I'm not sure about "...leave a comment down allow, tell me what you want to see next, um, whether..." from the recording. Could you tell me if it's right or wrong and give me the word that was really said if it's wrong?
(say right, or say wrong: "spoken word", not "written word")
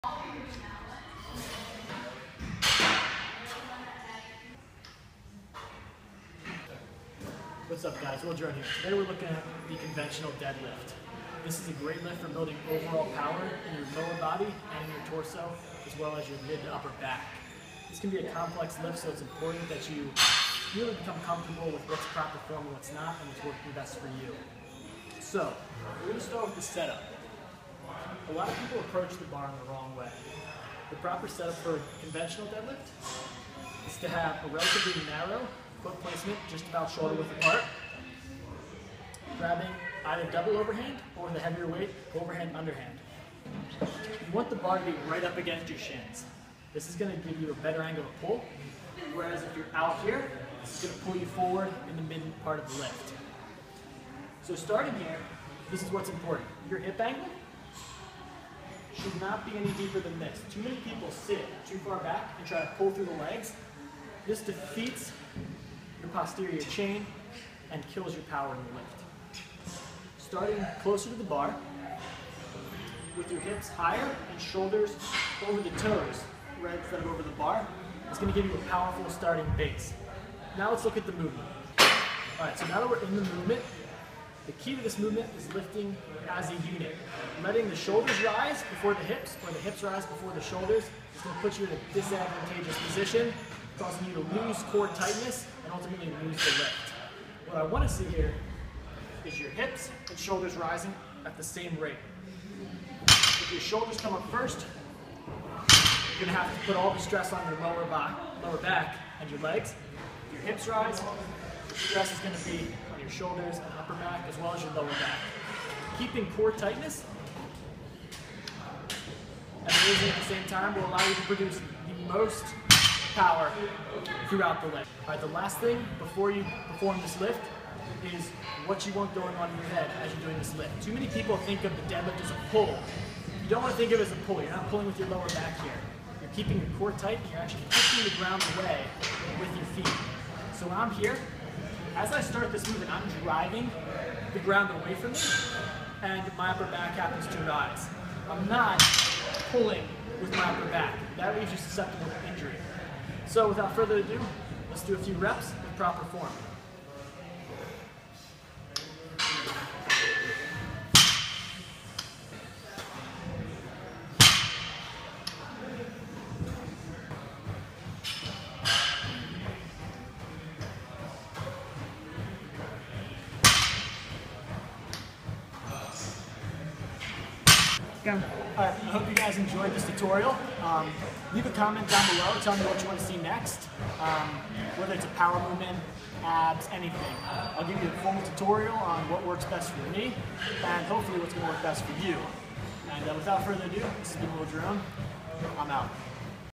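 wrong: "below", not "allow".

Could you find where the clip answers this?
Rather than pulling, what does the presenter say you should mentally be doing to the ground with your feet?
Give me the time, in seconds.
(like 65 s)
137 s.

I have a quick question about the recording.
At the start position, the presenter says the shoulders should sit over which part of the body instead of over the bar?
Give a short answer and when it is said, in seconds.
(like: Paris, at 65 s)
toes, at 75 s.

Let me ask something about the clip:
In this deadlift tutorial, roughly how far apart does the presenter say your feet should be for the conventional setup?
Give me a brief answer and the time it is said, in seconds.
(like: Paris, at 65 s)
shoulder width, at 36 s.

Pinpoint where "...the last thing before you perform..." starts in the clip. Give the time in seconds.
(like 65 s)
125 s.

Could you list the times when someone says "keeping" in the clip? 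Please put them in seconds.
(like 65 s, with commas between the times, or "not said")
115 s, 136 s.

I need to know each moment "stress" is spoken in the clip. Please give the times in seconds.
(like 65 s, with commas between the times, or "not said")
106 s, 111 s.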